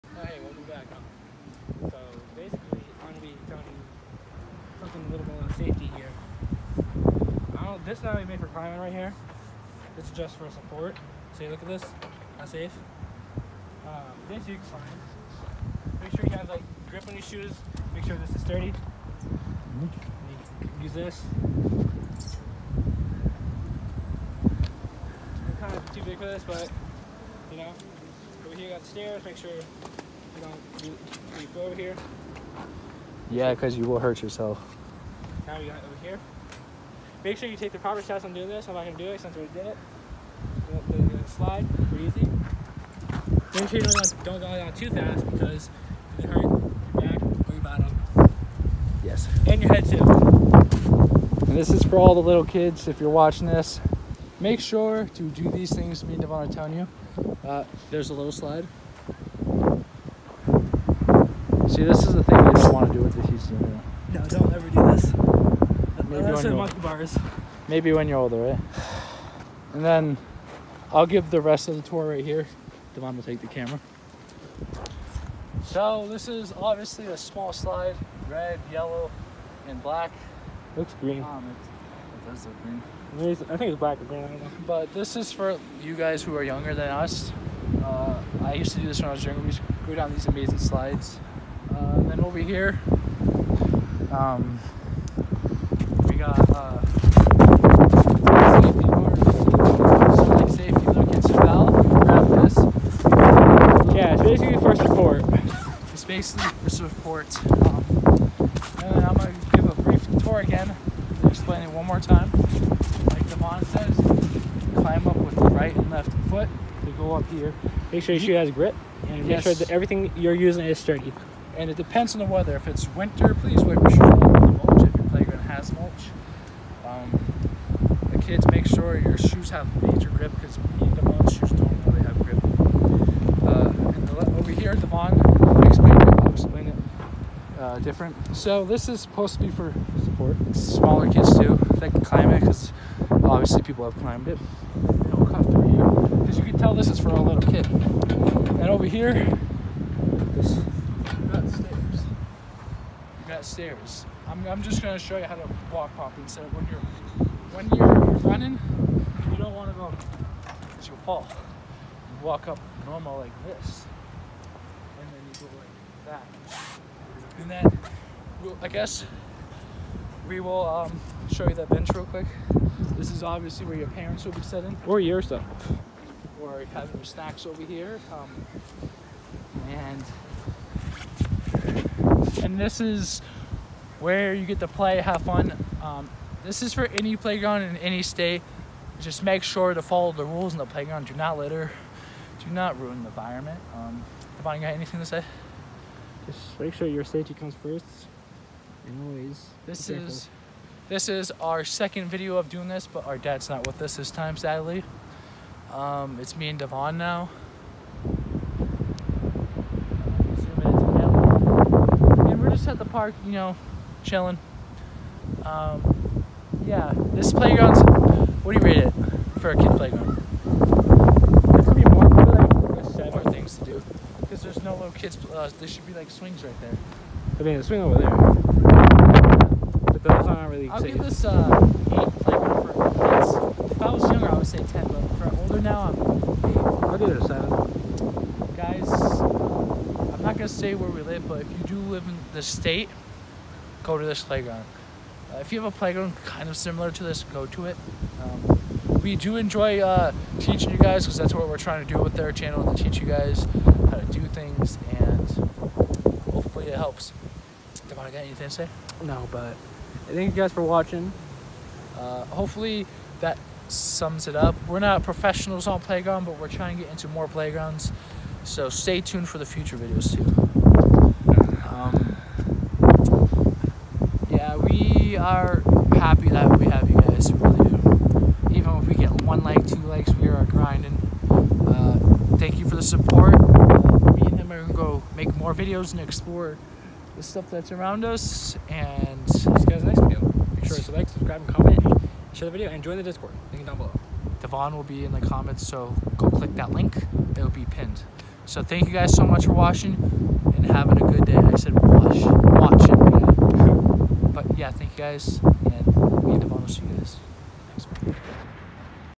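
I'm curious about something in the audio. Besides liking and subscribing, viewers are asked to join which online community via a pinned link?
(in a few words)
Discord.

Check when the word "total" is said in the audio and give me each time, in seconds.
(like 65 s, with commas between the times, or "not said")
not said.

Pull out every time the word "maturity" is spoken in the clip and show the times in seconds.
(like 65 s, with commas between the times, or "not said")
not said.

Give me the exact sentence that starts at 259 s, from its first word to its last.
No, but thank you guys for watching.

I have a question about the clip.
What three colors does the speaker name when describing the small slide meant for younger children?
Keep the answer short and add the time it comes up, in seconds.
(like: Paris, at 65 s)
red, yellow, and black, at 78 s.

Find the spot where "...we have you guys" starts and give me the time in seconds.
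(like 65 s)
276 s.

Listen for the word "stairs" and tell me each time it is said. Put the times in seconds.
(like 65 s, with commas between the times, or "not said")
28 s, 153 s.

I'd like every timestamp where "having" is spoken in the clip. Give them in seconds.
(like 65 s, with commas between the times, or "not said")
176 s, 300 s.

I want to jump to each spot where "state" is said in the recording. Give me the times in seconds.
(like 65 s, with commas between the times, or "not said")
188 s, 242 s.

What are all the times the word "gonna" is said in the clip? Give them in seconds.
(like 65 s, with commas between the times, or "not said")
109 s, 240 s.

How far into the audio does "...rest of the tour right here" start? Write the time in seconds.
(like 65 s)
71 s.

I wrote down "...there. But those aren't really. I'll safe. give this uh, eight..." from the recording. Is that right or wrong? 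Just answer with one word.
right.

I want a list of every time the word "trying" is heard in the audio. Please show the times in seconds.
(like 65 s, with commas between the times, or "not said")
251 s, 266 s.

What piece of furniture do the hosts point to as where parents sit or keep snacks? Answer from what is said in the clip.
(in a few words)
bench.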